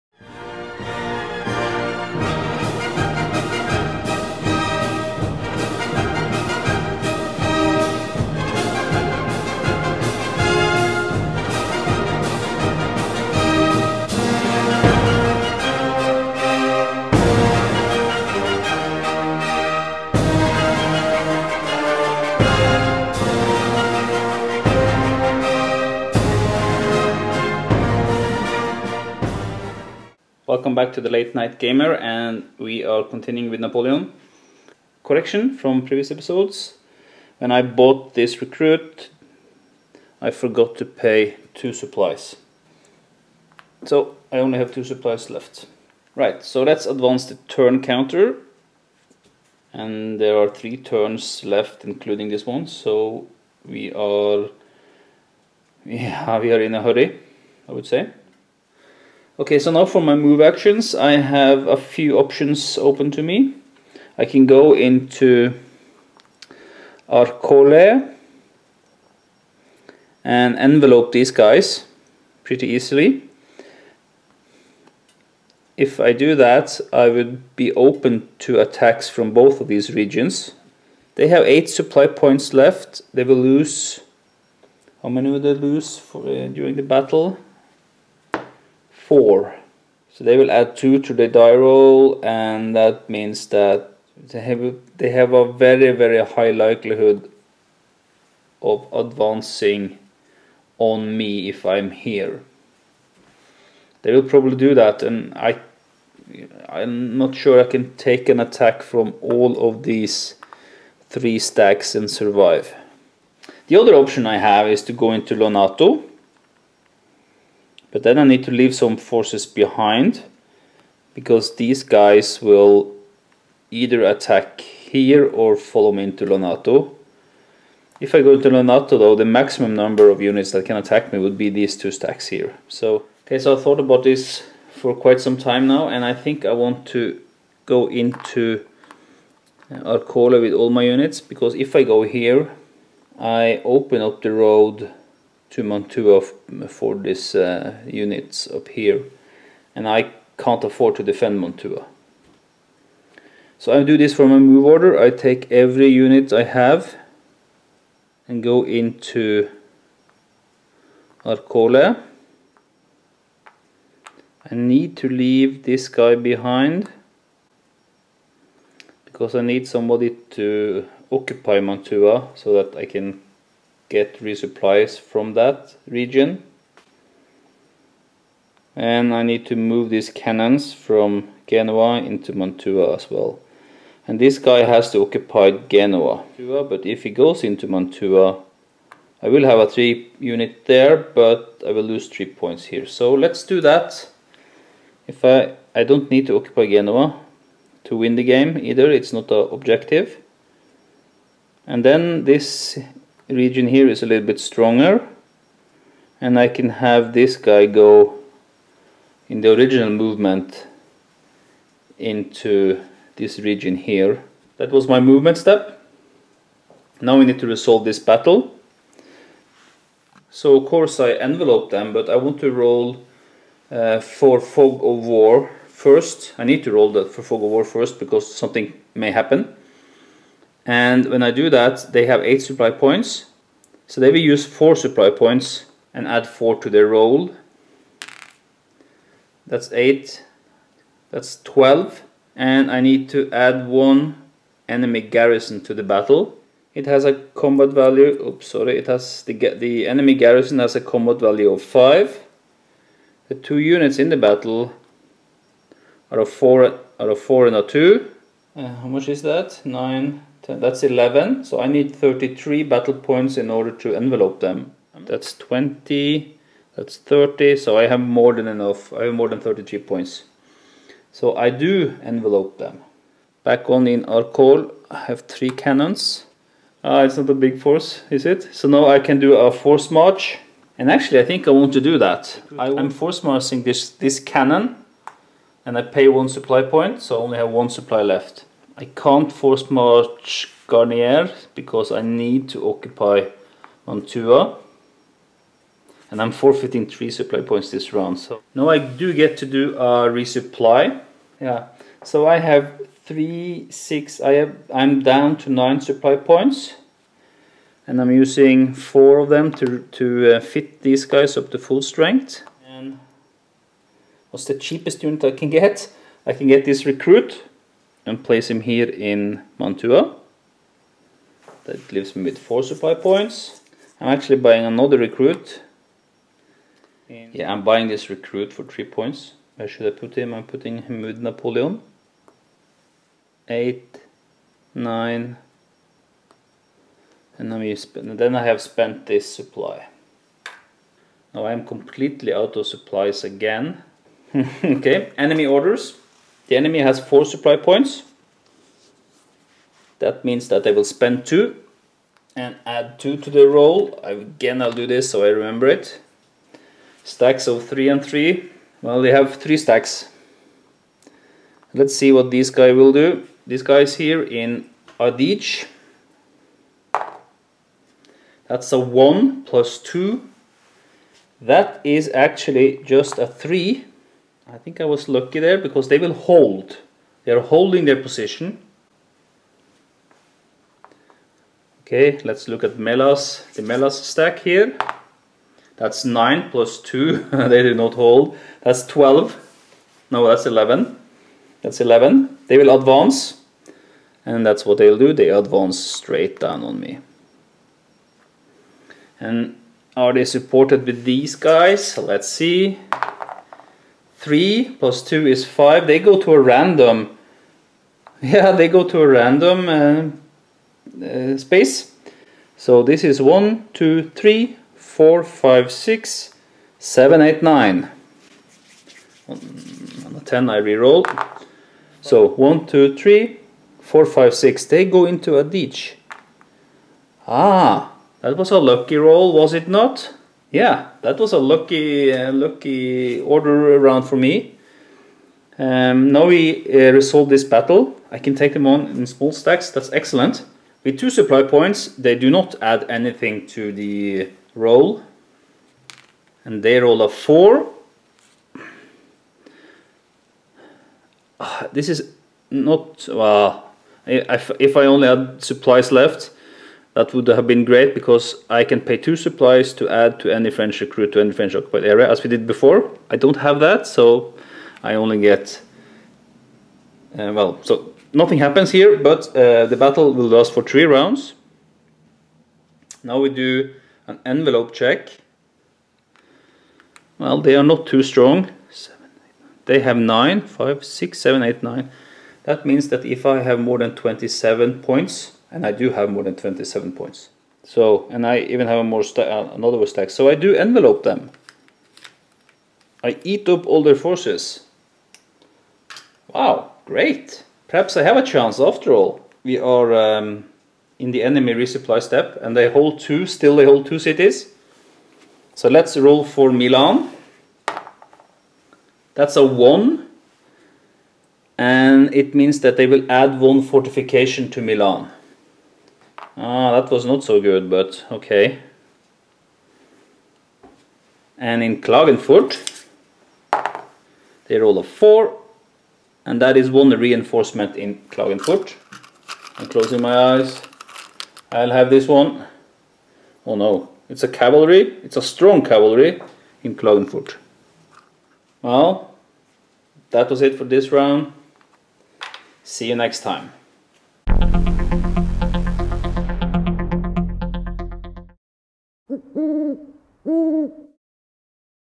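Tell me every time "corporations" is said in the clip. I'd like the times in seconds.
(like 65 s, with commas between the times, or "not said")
not said.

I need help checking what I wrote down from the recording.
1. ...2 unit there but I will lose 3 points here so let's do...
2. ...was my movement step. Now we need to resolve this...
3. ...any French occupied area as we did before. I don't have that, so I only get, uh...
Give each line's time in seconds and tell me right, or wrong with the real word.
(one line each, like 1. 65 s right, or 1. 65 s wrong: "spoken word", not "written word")
1. 189 s wrong: "3", not "2"
2. 214 s right
3. 461 s right.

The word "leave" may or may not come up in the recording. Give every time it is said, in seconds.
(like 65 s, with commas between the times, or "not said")
118 s, 165 s, 321 s.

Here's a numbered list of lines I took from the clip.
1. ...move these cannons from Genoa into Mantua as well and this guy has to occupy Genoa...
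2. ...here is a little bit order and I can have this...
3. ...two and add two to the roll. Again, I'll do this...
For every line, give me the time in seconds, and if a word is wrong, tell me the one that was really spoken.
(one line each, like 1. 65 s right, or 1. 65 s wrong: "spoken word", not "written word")
1. 179 s right
2. 203 s wrong: "stronger", not "order"
3. 351 s right.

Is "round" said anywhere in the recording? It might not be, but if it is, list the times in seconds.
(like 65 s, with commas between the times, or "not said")
297 s, 433 s, 470 s, 540 s.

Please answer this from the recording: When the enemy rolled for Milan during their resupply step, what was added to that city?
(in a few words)
One fortification.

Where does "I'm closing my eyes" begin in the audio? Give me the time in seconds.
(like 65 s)
529 s.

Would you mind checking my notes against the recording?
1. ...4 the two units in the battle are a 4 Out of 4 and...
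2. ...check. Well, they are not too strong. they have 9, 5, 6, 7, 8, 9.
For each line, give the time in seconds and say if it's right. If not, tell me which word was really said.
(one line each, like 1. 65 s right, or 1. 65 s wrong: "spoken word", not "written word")
1. 251 s wrong: "5", not "4"
2. 474 s right.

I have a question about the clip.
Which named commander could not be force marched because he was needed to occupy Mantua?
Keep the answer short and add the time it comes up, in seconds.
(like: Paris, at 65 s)
Garnier, at 290 s.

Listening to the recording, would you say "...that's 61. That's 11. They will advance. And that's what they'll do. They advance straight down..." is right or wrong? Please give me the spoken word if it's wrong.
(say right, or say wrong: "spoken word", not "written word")
wrong: "11", not "61".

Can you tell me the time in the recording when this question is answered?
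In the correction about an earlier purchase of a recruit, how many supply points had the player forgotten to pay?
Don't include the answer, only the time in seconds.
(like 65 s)
40 s.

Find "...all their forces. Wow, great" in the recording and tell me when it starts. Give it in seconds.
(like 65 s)
493 s.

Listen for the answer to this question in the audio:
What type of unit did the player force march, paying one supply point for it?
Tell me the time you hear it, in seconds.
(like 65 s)
283 s.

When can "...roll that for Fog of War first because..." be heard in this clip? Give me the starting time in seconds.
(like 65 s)
226 s.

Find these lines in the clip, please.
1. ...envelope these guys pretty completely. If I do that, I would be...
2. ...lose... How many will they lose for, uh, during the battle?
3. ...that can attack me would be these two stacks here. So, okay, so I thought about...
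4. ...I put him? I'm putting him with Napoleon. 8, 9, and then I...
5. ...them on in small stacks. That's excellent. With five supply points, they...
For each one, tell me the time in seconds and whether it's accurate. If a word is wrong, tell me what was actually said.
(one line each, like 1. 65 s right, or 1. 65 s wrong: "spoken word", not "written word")
1. 70 s wrong: "easily", not "completely"
2. 83 s right
3. 130 s right
4. 329 s right
5. 438 s wrong: "two", not "five".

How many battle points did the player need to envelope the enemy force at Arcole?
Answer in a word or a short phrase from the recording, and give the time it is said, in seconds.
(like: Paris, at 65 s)
33, at 261 s.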